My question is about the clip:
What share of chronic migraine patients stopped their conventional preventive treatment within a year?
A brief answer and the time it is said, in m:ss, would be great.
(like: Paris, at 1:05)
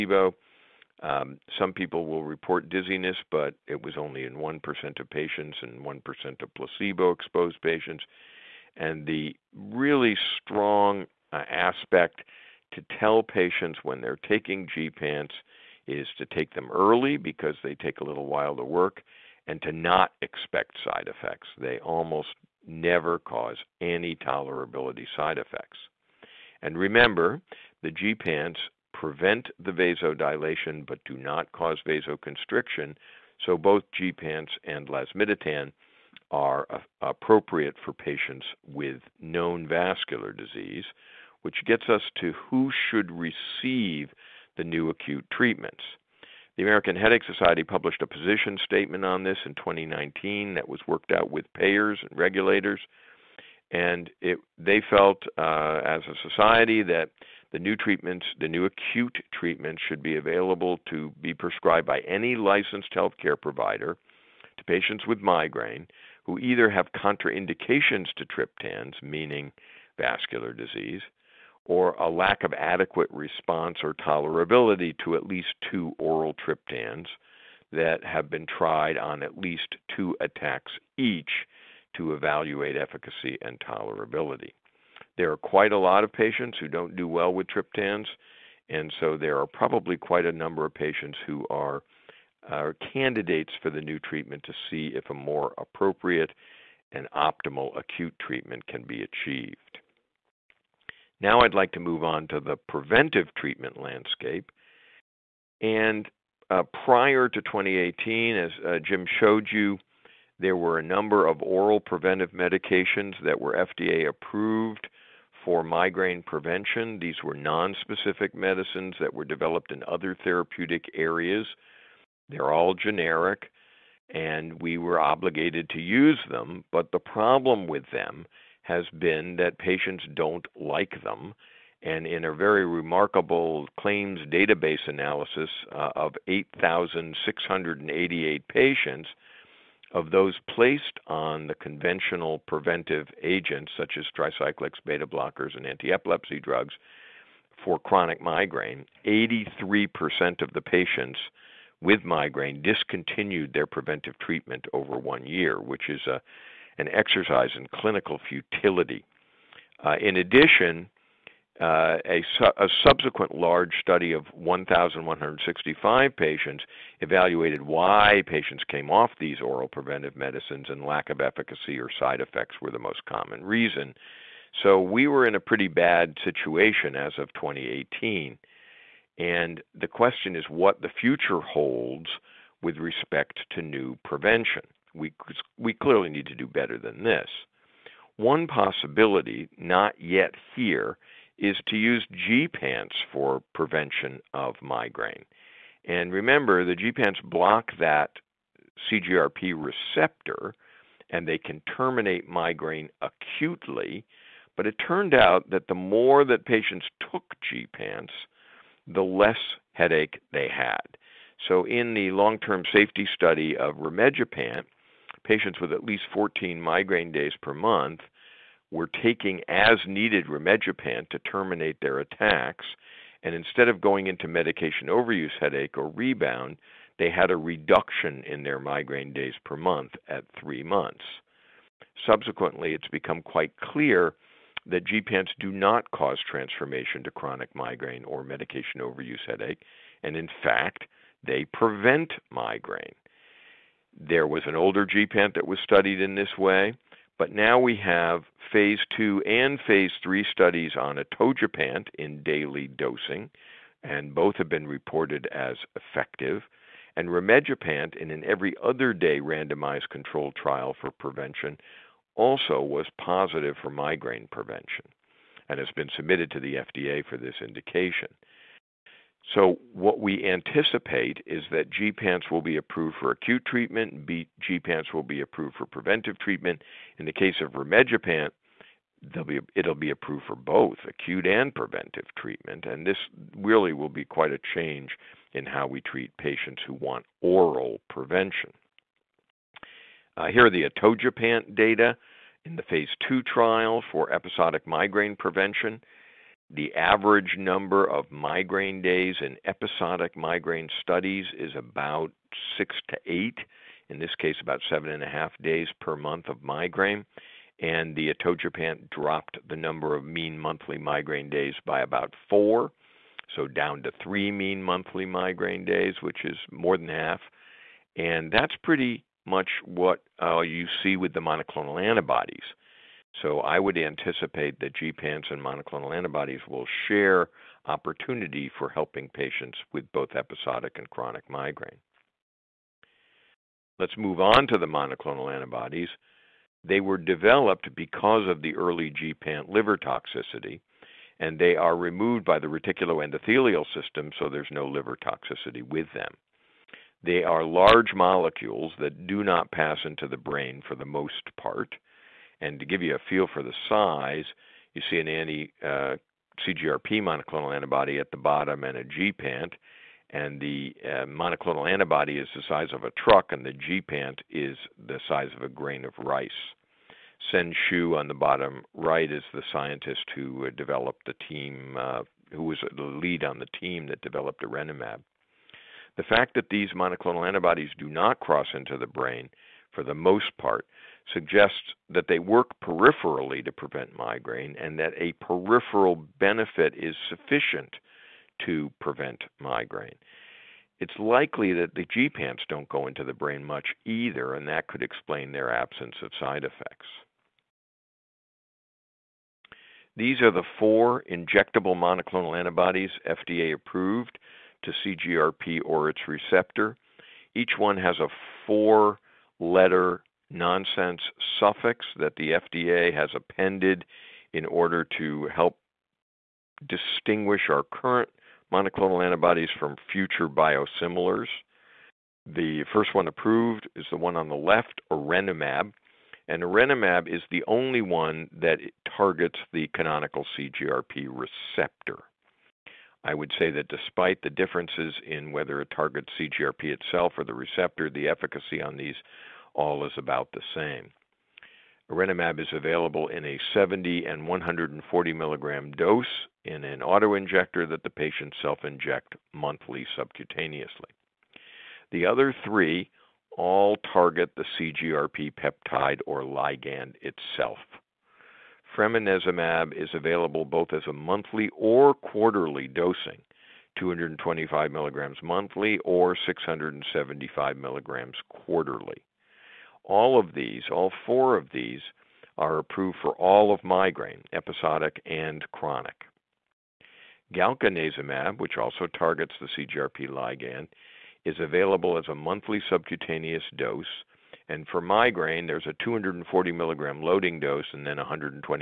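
83%, at 2:29.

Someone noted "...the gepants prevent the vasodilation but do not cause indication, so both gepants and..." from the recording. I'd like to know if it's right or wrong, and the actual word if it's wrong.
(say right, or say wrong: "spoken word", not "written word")
wrong: "vasoconstriction", not "indication".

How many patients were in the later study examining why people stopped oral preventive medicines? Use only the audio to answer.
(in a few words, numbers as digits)
1,165.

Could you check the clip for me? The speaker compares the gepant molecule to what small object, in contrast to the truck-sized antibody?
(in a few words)
A grain of rice.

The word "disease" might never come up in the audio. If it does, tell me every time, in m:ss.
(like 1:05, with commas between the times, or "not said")
0:40, 1:10.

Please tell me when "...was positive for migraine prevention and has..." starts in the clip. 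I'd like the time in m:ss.
4:22.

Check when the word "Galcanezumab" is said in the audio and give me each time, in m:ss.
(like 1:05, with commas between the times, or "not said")
7:57.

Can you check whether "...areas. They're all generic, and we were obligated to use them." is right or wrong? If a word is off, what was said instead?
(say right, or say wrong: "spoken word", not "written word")
right.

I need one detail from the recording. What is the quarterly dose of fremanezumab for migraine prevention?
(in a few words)
675 milligrams.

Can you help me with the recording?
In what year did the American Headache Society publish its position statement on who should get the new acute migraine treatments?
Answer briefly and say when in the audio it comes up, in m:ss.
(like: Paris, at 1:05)
2019, at 0:49.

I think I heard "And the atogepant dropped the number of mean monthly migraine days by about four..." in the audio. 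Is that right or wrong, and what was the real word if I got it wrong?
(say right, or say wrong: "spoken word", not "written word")
right.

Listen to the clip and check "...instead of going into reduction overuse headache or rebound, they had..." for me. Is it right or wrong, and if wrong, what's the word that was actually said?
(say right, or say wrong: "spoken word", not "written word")
wrong: "medication", not "reduction".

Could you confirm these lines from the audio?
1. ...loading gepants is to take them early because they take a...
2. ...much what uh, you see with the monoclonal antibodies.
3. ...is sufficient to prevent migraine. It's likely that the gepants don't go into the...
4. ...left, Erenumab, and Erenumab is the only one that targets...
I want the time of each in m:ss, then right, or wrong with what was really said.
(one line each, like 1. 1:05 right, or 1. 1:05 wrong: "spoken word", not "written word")
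1. 0:14 wrong: "taking", not "loading"
2. 5:19 right
3. 6:26 right
4. 7:04 right.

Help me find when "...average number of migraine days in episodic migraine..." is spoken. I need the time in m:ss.
4:56.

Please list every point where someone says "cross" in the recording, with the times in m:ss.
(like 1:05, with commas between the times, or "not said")
6:18.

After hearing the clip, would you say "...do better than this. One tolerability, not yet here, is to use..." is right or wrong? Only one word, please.
wrong.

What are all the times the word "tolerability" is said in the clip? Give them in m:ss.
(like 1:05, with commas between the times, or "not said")
0:24, 1:13, 1:23.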